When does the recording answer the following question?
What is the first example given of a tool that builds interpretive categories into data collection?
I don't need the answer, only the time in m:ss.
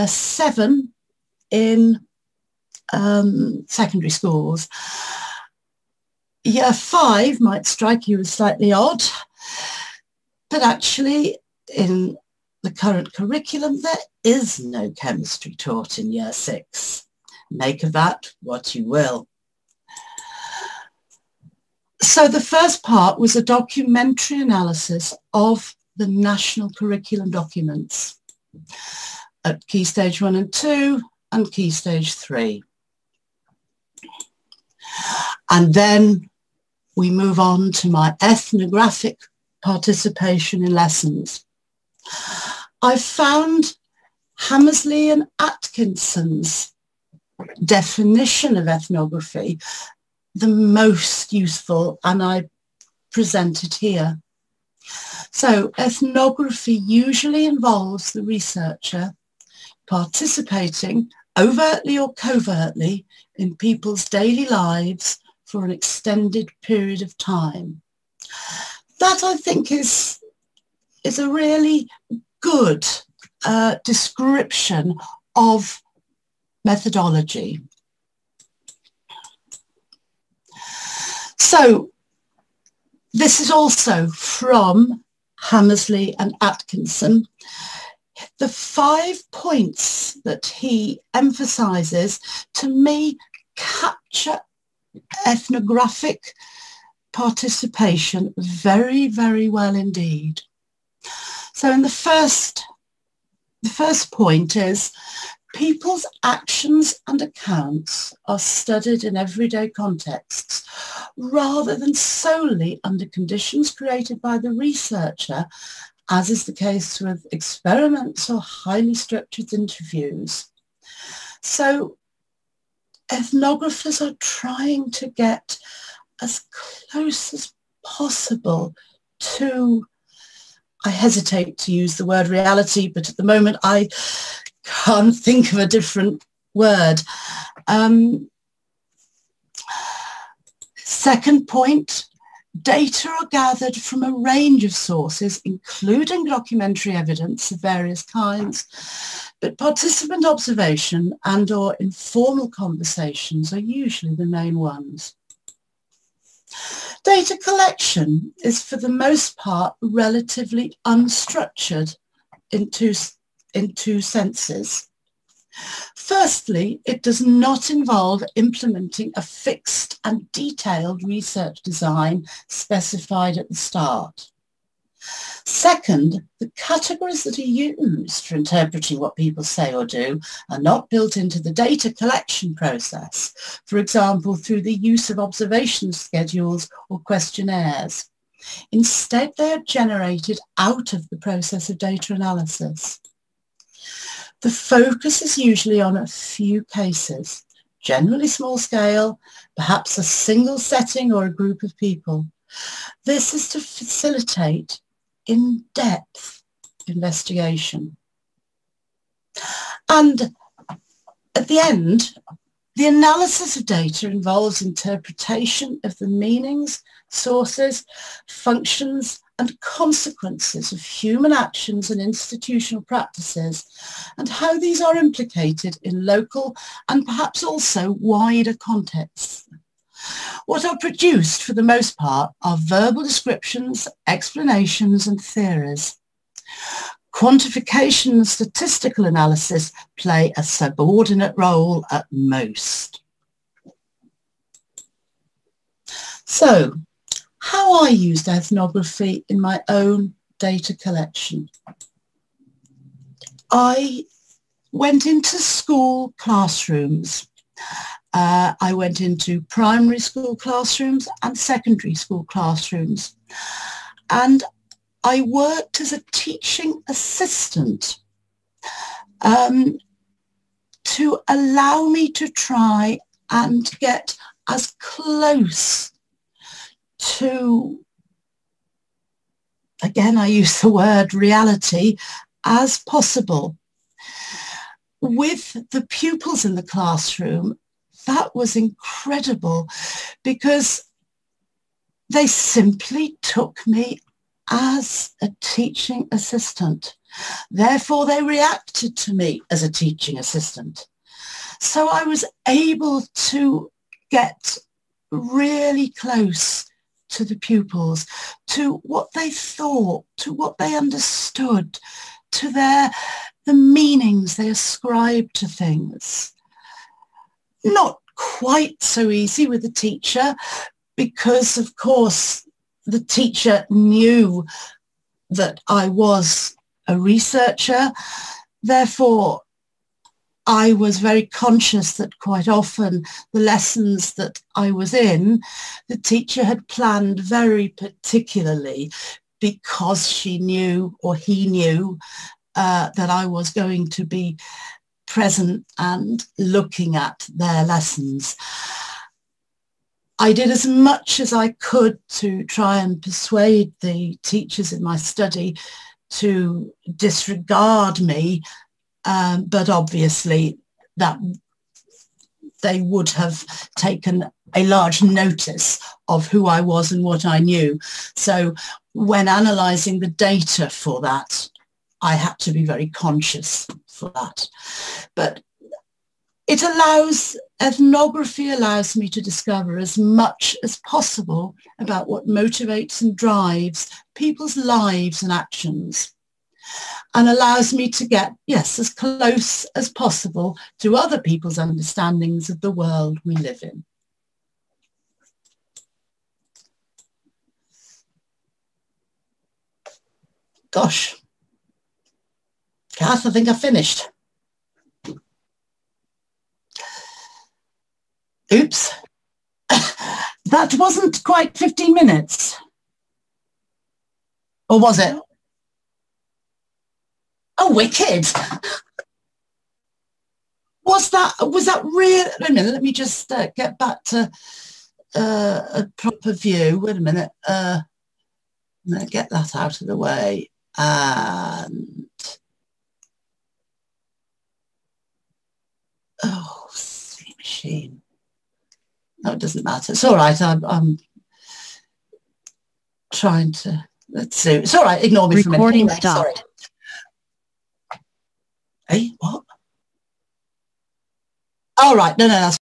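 3:05.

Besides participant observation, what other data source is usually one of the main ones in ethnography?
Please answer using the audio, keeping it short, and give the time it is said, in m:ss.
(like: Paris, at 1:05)
Informal conversations, at 2:31.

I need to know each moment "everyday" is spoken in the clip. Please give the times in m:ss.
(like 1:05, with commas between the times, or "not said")
1:49.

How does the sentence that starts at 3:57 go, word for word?
Quantification and statistical analysis play a subordinate role at most.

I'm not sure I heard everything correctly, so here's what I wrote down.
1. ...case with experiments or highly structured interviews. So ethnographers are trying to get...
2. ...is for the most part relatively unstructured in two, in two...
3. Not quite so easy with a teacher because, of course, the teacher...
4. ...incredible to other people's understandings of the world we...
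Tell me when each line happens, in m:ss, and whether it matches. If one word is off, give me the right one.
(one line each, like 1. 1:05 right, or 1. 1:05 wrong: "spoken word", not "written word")
1. 1:56 right
2. 2:38 right
3. 5:17 right
4. 6:29 wrong: "possible", not "incredible".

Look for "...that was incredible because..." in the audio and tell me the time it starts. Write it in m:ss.
4:48.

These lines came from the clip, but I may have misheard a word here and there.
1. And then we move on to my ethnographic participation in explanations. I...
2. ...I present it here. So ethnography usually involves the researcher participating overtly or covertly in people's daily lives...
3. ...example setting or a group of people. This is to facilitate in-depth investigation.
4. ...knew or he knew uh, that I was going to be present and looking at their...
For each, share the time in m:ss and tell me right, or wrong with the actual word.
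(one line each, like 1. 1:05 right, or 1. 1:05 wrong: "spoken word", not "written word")
1. 0:35 wrong: "lessons", not "explanations"
2. 0:52 right
3. 3:20 wrong: "single", not "example"
4. 5:40 right.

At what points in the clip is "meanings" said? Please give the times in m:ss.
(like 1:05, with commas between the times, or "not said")
3:36, 5:13.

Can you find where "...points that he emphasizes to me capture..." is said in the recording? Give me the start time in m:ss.
1:29.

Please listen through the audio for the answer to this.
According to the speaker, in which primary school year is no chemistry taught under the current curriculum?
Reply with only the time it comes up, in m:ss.
0:16.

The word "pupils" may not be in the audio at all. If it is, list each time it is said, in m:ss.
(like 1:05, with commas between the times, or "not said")
4:45, 5:07.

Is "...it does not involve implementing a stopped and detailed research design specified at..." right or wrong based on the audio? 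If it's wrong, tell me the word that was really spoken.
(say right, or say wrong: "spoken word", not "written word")
wrong: "fixed", not "stopped".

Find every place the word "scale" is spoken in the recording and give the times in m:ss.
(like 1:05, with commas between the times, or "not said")
3:18.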